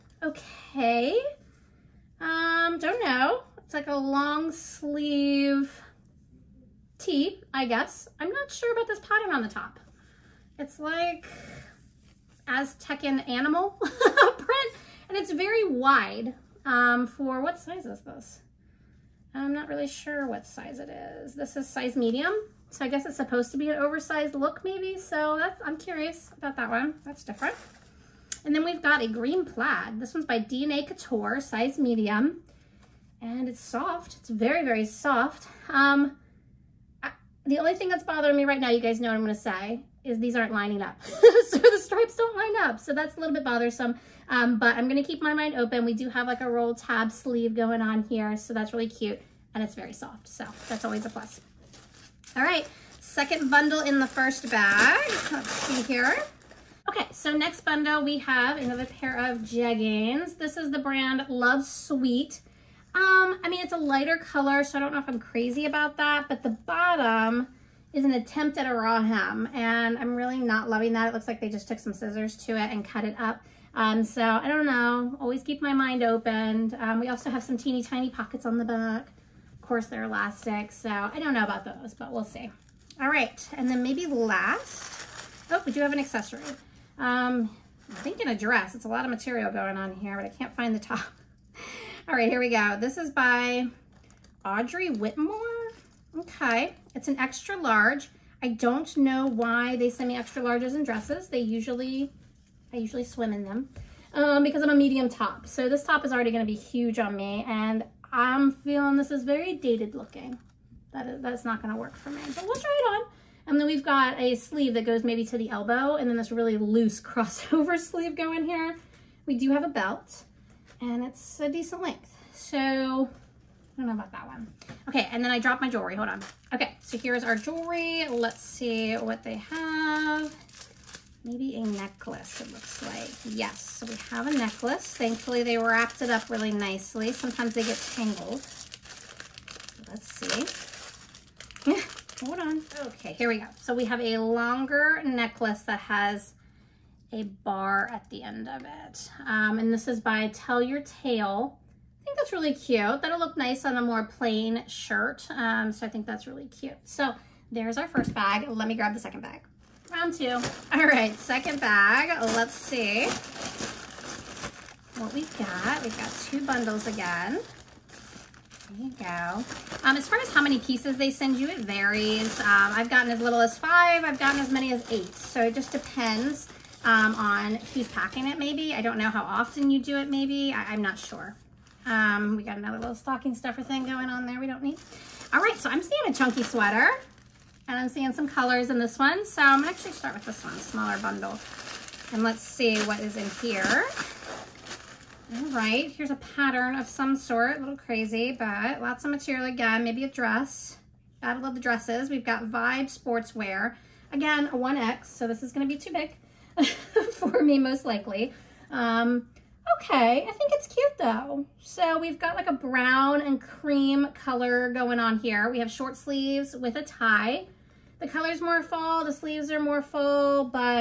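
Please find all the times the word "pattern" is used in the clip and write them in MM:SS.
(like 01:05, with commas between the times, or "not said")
00:08, 03:16.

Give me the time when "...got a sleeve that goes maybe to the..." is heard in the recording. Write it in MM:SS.
01:53.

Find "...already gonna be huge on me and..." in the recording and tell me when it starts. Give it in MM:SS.
01:46.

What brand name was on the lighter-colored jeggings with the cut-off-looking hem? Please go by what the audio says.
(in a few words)
Love Sweet.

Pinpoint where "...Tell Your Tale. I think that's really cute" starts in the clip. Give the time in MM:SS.
02:30.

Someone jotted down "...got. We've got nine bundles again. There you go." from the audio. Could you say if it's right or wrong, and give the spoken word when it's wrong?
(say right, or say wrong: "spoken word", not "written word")
wrong: "two", not "nine".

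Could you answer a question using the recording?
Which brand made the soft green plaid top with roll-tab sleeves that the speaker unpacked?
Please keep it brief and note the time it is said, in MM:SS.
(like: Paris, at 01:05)
DNA Couture, at 00:30.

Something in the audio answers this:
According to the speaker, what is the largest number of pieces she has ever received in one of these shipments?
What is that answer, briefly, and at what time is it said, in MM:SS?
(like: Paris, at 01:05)
8, at 02:54.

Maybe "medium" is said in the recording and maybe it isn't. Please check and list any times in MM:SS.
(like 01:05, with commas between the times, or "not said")
00:21, 00:31, 01:44.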